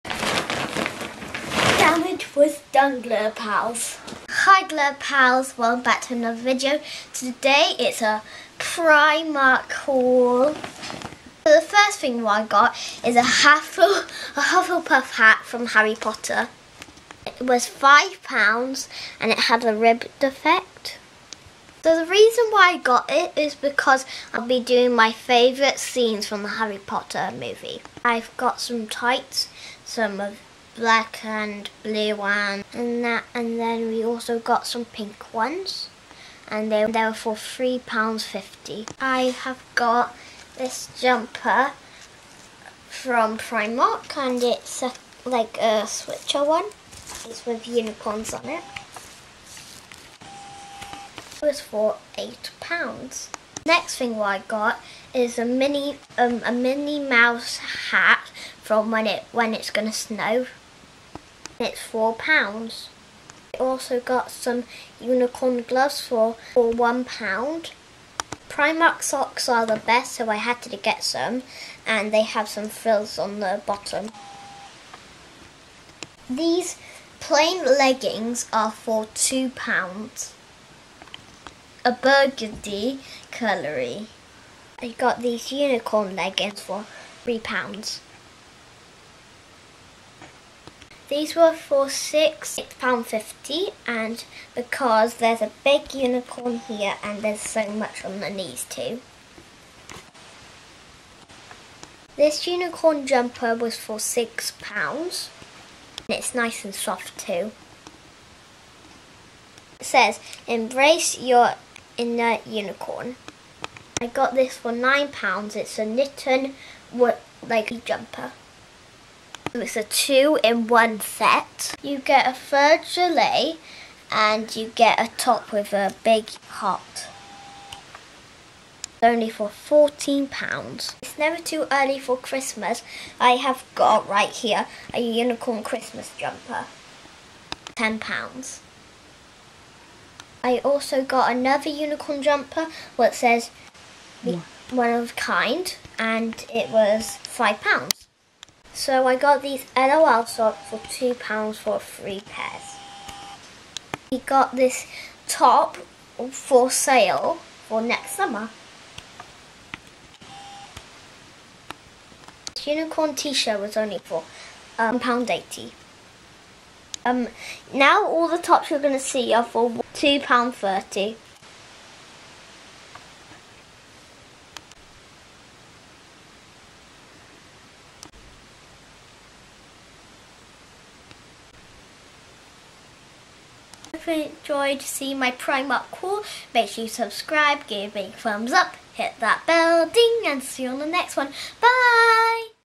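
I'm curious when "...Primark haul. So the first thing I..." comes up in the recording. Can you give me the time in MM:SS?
00:08.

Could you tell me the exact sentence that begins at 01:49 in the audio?
It says, embrace your inner unicorn.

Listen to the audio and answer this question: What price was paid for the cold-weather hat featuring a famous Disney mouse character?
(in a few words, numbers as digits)
£4.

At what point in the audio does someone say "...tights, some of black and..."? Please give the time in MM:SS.
00:28.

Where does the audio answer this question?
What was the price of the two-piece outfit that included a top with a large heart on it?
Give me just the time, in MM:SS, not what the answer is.
02:09.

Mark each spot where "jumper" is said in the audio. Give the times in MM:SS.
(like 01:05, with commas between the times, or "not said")
00:40, 01:43, 01:57, 02:16, 02:22.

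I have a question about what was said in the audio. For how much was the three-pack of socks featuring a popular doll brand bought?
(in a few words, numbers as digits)
£2.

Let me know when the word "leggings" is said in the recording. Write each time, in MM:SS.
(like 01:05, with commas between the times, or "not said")
01:17, 01:26.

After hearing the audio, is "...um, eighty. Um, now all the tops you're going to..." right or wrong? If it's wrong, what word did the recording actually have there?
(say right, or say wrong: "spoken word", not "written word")
right.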